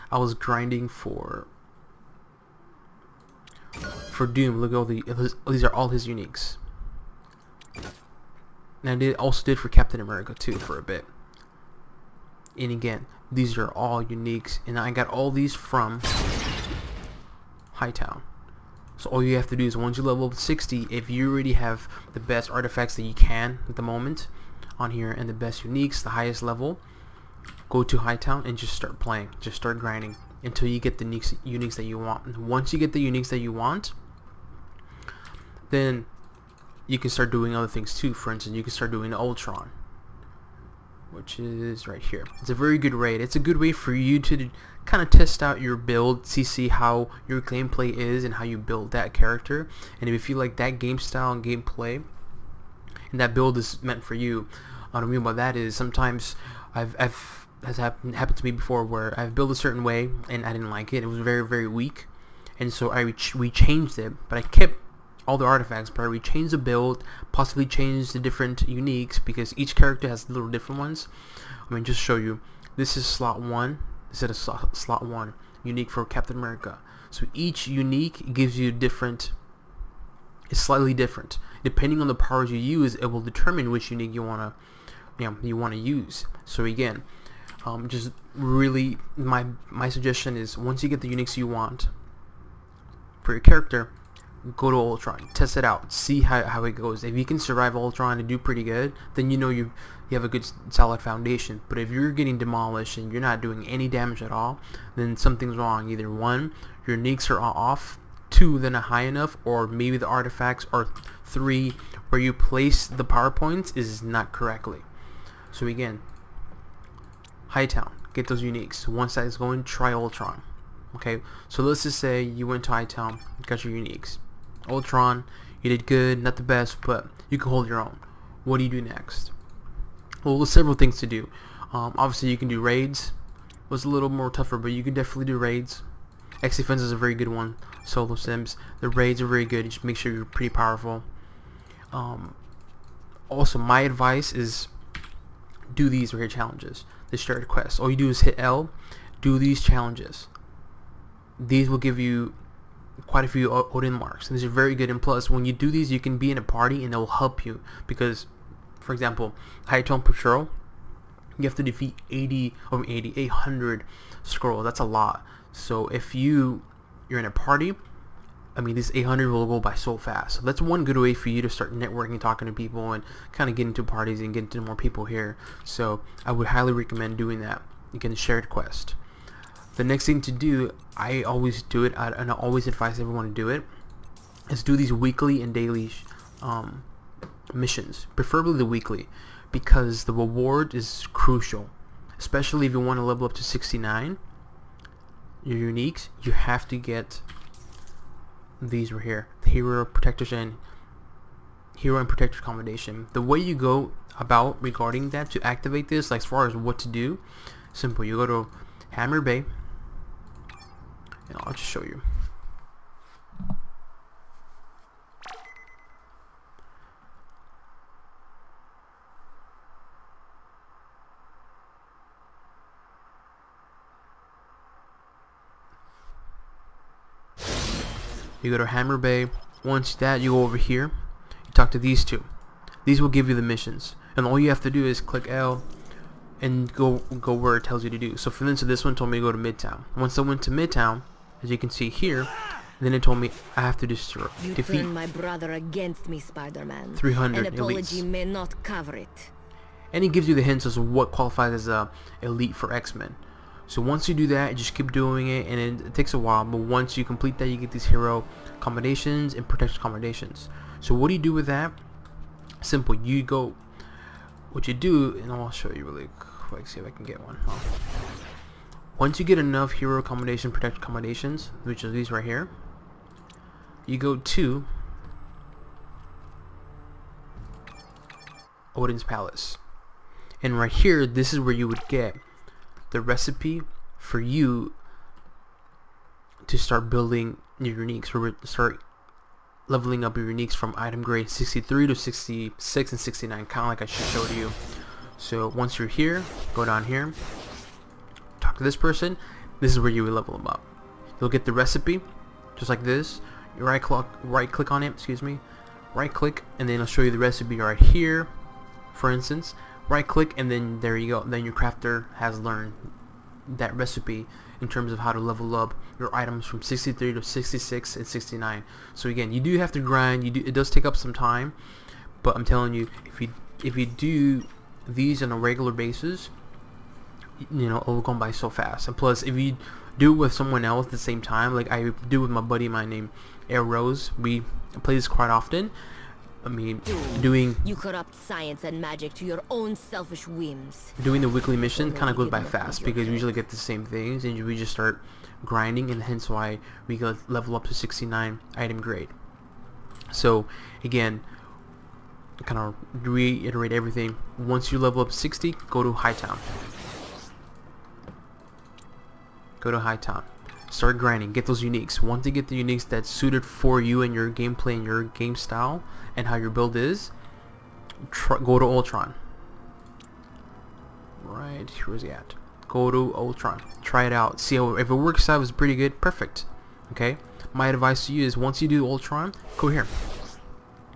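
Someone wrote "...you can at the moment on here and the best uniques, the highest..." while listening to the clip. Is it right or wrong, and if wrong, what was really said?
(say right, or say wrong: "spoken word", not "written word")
right.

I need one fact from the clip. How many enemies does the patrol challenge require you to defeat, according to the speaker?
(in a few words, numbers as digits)
800.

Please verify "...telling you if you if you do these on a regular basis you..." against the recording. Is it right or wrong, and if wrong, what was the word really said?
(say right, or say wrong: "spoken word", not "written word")
right.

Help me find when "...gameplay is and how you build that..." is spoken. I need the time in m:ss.
0:47.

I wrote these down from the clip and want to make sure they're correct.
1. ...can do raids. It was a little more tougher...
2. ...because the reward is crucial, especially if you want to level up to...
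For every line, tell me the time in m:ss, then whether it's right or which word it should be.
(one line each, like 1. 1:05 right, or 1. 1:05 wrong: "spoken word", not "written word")
1. 2:12 right
2. 3:09 right.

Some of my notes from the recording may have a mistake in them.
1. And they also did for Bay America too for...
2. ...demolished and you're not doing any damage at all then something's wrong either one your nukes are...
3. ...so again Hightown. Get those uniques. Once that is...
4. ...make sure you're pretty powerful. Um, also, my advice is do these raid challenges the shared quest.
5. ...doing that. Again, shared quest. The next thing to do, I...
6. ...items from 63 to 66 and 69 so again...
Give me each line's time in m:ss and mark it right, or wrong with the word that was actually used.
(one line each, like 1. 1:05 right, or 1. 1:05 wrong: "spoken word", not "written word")
1. 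0:08 wrong: "Captain", not "Bay"
2. 1:42 right
3. 1:55 right
4. 2:19 right
5. 2:57 right
6. 5:16 right.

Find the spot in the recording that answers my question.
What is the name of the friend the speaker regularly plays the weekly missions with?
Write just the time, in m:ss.
5:33.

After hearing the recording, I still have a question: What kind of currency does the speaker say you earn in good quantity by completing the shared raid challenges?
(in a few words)
Odin marks.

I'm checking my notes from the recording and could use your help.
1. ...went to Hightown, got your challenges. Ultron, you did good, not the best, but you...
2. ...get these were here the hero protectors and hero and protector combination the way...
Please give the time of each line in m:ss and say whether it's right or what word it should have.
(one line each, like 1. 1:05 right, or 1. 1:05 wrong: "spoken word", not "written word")
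1. 2:02 wrong: "uniques", not "challenges"
2. 3:16 right.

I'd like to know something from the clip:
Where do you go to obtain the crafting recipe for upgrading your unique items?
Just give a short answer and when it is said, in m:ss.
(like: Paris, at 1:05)
Odin's Palace, at 4:38.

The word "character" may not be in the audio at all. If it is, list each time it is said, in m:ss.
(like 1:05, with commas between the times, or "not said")
0:49, 1:09, 1:33.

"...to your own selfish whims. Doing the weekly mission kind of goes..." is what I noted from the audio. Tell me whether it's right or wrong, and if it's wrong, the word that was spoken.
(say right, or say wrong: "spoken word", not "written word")
right.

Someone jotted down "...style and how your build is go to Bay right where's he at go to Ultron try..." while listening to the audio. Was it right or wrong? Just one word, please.
wrong.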